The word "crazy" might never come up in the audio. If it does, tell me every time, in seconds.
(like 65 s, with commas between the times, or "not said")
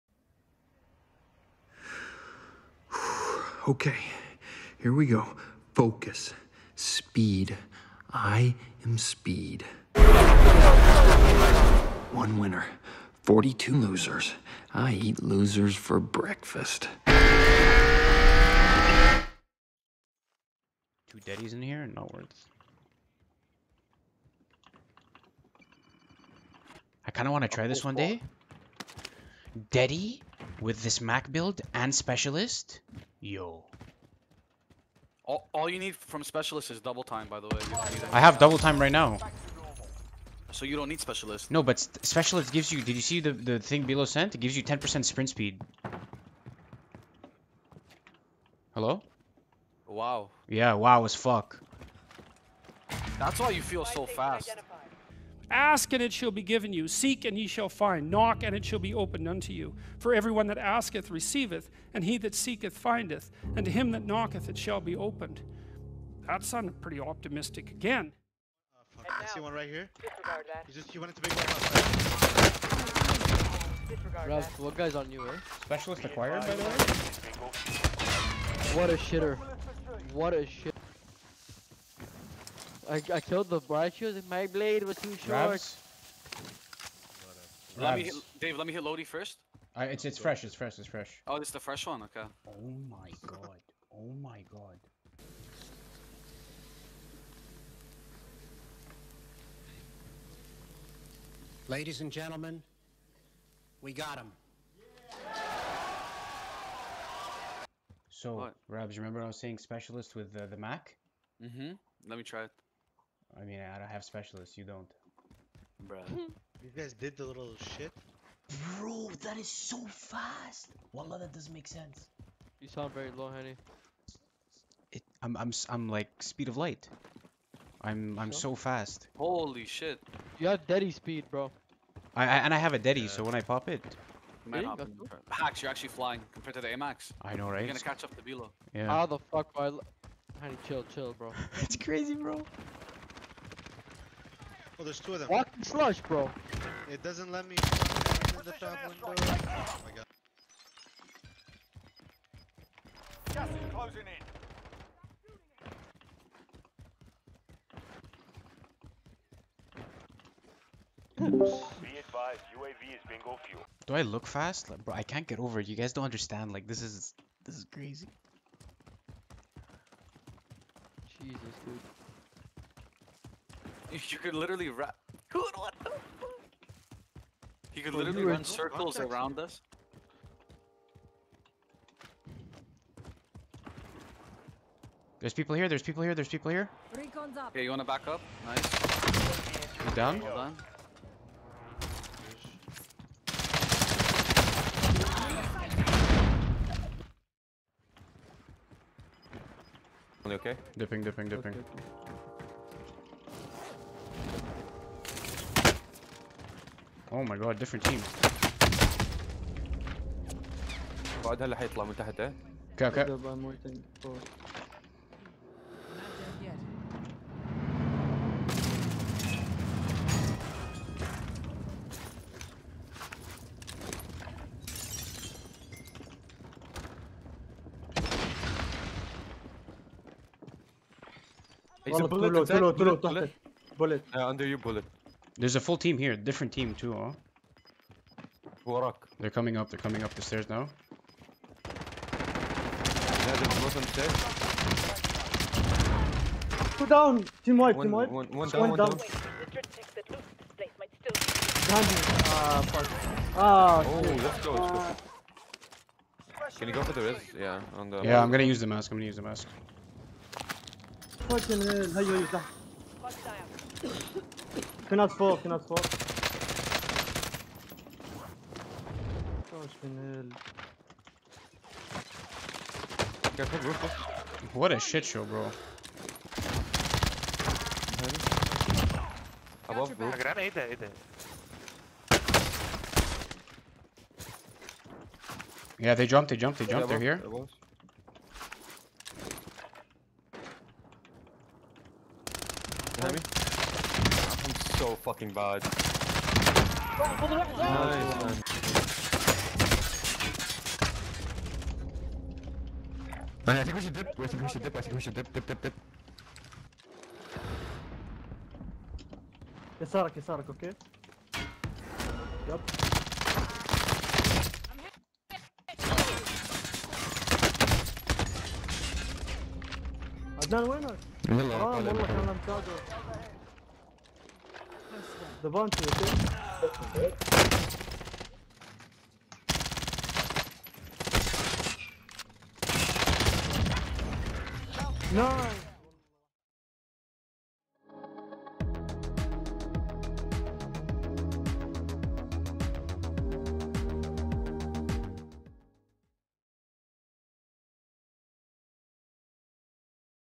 141 s, 167 s.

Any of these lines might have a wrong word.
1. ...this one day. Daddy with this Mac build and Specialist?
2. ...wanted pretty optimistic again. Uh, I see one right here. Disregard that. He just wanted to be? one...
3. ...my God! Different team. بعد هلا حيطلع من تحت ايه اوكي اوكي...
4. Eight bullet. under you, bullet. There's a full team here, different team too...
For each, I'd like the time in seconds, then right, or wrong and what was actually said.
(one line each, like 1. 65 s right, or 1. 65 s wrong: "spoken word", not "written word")
1. 27 s right
2. 66 s wrong: "sounded", not "wanted"
3. 207 s right
4. 232 s wrong: "Two", not "Eight".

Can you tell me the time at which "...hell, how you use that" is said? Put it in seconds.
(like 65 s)
261 s.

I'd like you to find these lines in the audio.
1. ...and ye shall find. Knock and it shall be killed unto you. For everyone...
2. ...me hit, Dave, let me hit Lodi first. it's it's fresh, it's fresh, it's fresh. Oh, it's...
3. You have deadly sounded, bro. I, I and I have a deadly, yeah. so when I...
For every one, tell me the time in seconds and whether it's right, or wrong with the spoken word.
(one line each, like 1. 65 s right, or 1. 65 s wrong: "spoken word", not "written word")
1. 57 s wrong: "opened", not "killed"
2. 87 s right
3. 130 s wrong: "speed", not "sounded".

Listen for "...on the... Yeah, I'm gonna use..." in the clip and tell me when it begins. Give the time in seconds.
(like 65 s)
257 s.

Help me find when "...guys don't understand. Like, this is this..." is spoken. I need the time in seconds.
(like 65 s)
165 s.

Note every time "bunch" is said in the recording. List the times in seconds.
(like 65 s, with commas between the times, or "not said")
325 s.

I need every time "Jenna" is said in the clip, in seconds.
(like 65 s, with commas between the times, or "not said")
not said.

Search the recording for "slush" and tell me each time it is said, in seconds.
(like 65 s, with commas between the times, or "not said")
145 s.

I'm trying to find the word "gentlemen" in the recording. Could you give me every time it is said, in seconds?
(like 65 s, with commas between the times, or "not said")
102 s.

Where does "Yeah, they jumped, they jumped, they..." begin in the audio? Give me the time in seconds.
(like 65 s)
285 s.